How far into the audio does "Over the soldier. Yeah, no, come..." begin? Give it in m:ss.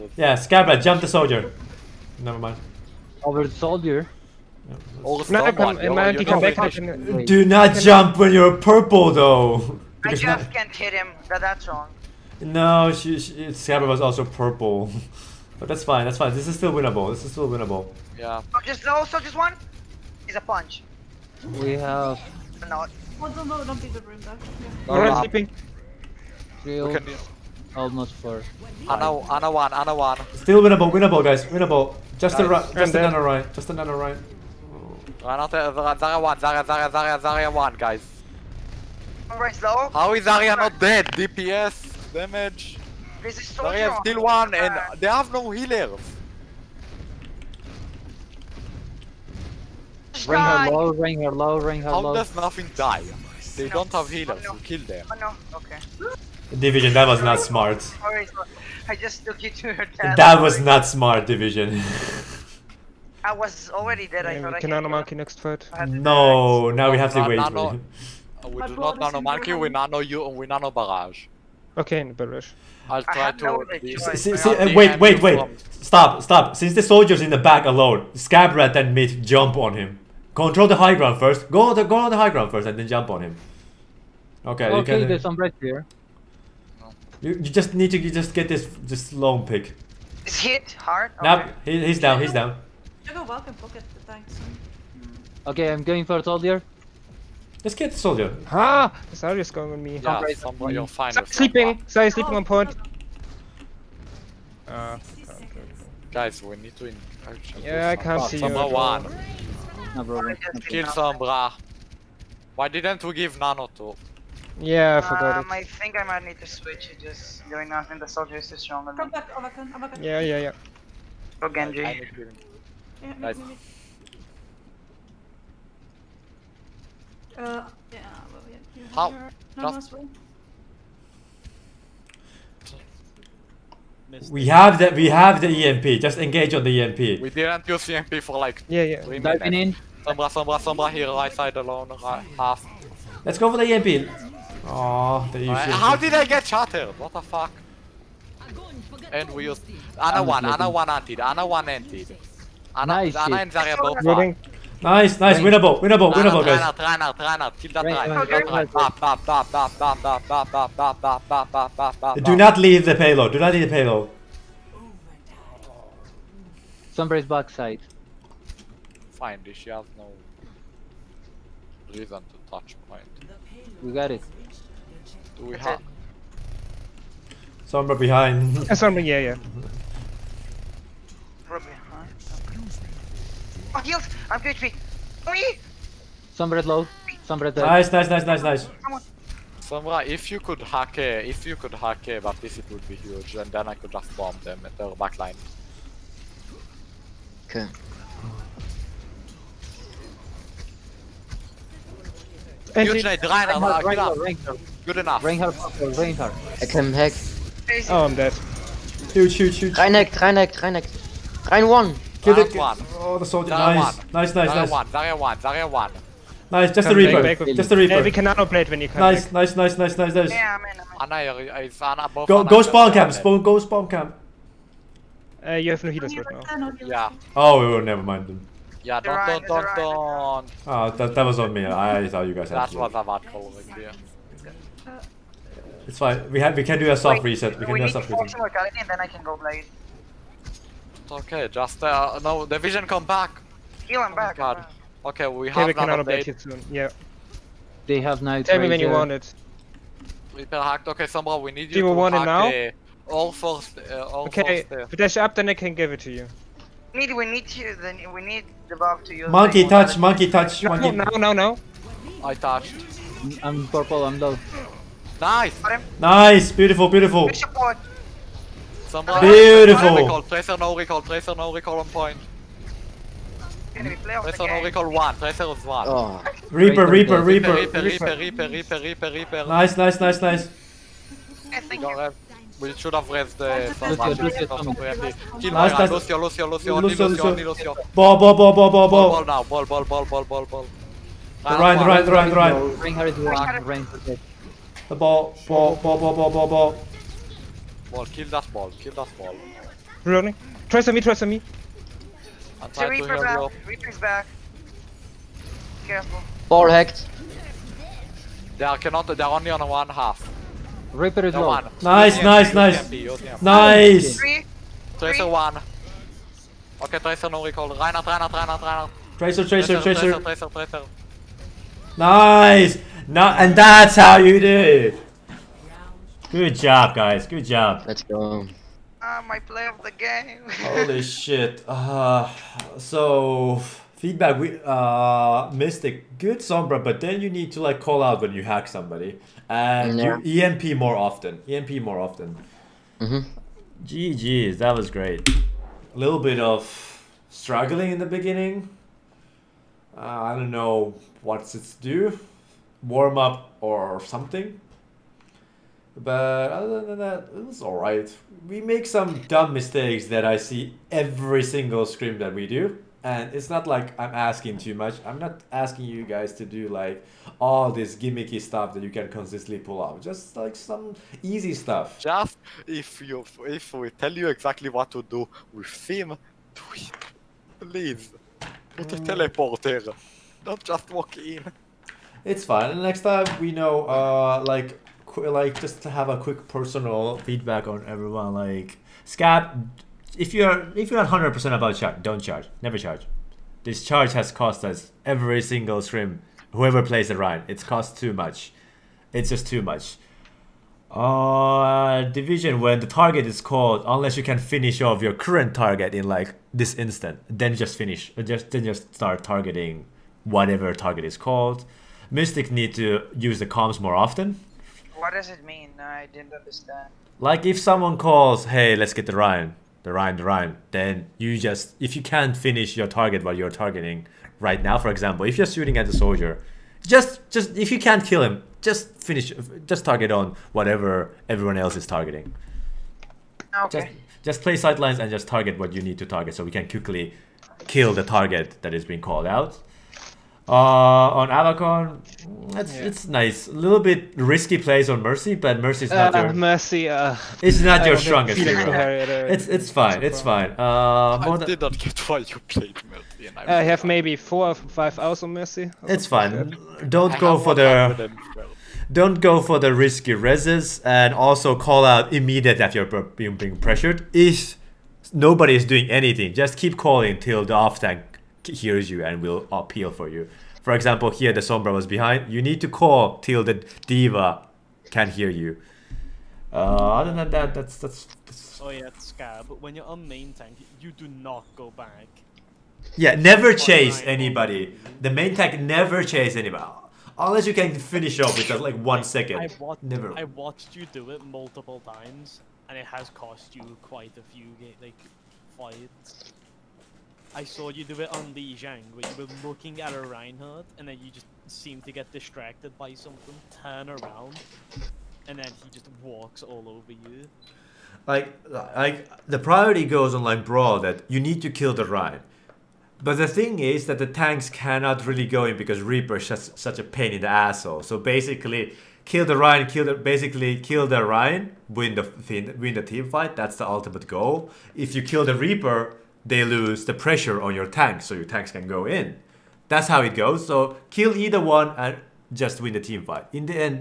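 0:03.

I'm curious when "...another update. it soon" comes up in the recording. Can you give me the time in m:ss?
4:05.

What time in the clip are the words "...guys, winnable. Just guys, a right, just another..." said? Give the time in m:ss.
0:31.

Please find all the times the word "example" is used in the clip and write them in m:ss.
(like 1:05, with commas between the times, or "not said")
7:04, 7:50.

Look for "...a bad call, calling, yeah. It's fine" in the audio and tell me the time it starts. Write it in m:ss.
3:52.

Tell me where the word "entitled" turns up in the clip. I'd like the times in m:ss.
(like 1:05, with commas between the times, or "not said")
not said.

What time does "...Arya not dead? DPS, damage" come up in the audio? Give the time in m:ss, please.
0:40.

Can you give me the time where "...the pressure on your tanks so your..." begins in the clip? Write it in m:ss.
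8:46.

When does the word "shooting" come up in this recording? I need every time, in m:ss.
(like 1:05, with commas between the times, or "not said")
7:05.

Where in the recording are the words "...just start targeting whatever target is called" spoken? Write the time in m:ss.
6:48.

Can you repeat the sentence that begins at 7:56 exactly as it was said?
Uh, other than that, that's, that's, that's...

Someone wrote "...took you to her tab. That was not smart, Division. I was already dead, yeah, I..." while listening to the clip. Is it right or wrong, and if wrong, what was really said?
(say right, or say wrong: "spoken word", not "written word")
right.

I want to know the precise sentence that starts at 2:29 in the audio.
And we used another one, another one anti another one anti.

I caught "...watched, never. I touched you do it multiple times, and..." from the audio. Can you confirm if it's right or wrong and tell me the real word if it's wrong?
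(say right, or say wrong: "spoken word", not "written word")
wrong: "watched", not "touched".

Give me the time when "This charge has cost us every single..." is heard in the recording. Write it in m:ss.
6:33.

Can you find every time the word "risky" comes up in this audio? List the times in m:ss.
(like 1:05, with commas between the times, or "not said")
7:24, 7:39.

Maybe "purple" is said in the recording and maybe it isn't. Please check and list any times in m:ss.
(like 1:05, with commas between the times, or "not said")
0:08, 0:14, 4:23.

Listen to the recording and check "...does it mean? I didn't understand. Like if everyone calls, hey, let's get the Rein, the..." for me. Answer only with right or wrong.
wrong.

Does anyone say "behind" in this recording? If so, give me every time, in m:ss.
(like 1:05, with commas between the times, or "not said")
2:57, 7:51.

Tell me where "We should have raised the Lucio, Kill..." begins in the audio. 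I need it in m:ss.
4:42.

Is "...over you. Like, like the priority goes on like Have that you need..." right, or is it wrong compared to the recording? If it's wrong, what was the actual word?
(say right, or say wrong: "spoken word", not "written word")
wrong: "Brawl", not "Have".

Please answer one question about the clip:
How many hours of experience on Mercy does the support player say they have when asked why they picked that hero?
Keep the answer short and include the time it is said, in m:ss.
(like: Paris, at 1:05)
4 or 5, at 7:34.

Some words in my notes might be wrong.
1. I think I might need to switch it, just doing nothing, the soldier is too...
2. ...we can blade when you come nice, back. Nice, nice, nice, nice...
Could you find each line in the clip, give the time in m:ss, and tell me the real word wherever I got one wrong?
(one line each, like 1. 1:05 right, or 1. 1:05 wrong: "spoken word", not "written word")
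1. 1:55 right
2. 3:38 wrong: "nanoblade", not "blade".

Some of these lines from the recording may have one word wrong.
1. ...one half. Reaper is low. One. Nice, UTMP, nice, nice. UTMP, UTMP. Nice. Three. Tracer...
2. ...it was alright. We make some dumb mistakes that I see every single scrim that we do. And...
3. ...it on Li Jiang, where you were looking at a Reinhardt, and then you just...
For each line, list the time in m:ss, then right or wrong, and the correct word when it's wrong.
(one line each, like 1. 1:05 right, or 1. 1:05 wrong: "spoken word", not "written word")
1. 5:09 right
2. 5:57 right
3. 8:17 right.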